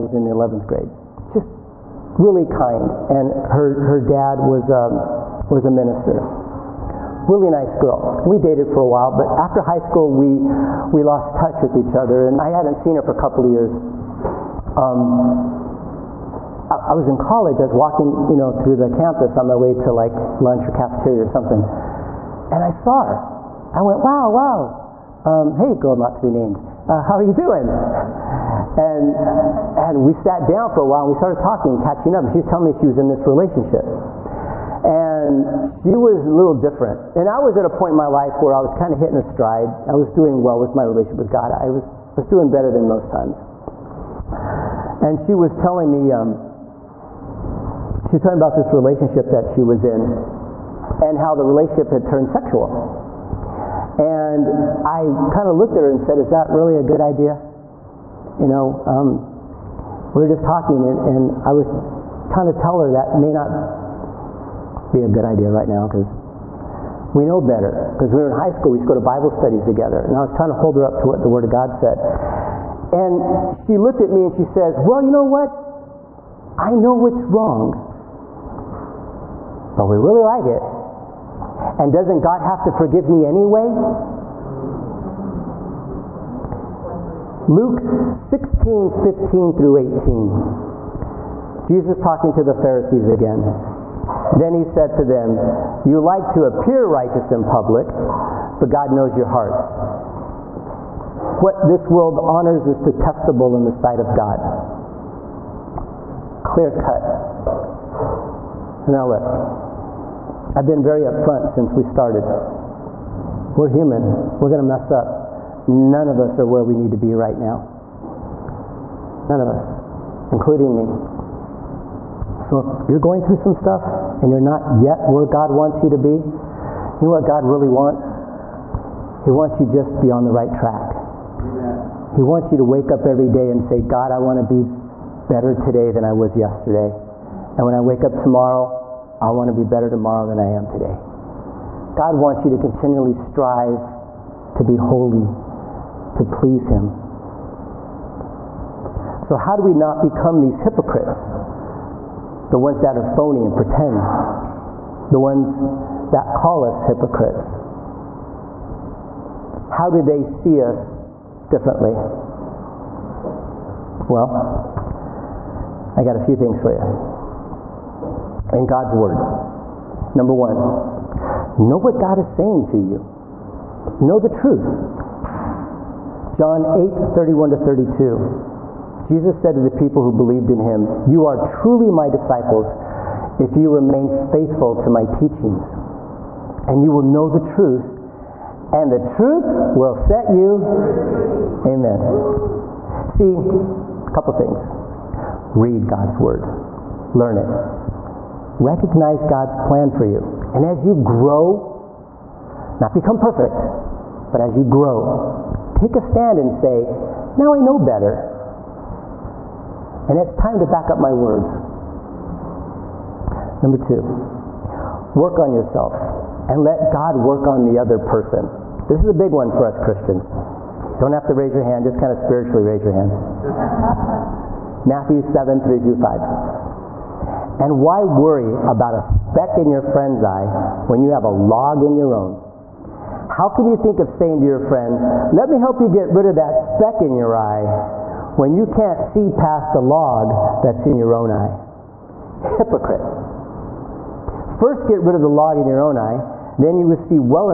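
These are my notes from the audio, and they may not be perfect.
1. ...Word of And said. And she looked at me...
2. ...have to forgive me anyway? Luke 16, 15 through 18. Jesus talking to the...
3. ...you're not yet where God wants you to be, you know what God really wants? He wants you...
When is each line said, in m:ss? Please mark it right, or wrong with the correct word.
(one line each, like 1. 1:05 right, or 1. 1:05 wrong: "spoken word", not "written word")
1. 1:11 wrong: "God", not "And"
2. 1:22 right
3. 2:04 right.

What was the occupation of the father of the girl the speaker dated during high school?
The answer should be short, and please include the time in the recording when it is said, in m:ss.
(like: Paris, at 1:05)
Minister, at 0:05.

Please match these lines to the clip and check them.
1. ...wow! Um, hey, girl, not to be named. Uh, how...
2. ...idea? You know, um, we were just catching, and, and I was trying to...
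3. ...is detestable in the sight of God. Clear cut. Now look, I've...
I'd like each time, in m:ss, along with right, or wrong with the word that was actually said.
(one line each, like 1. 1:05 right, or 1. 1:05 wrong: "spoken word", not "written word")
1. 0:24 right
2. 0:56 wrong: "talking", not "catching"
3. 1:42 right.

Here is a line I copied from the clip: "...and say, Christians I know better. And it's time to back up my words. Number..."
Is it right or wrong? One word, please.
wrong.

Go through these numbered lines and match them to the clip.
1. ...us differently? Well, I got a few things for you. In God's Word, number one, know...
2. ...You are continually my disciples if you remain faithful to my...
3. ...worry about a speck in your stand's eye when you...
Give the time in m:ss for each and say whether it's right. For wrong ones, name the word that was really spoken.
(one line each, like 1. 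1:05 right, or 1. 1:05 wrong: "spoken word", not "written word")
1. 2:40 right
2. 3:01 wrong: "truly", not "continually"
3. 3:48 wrong: "friend", not "stand".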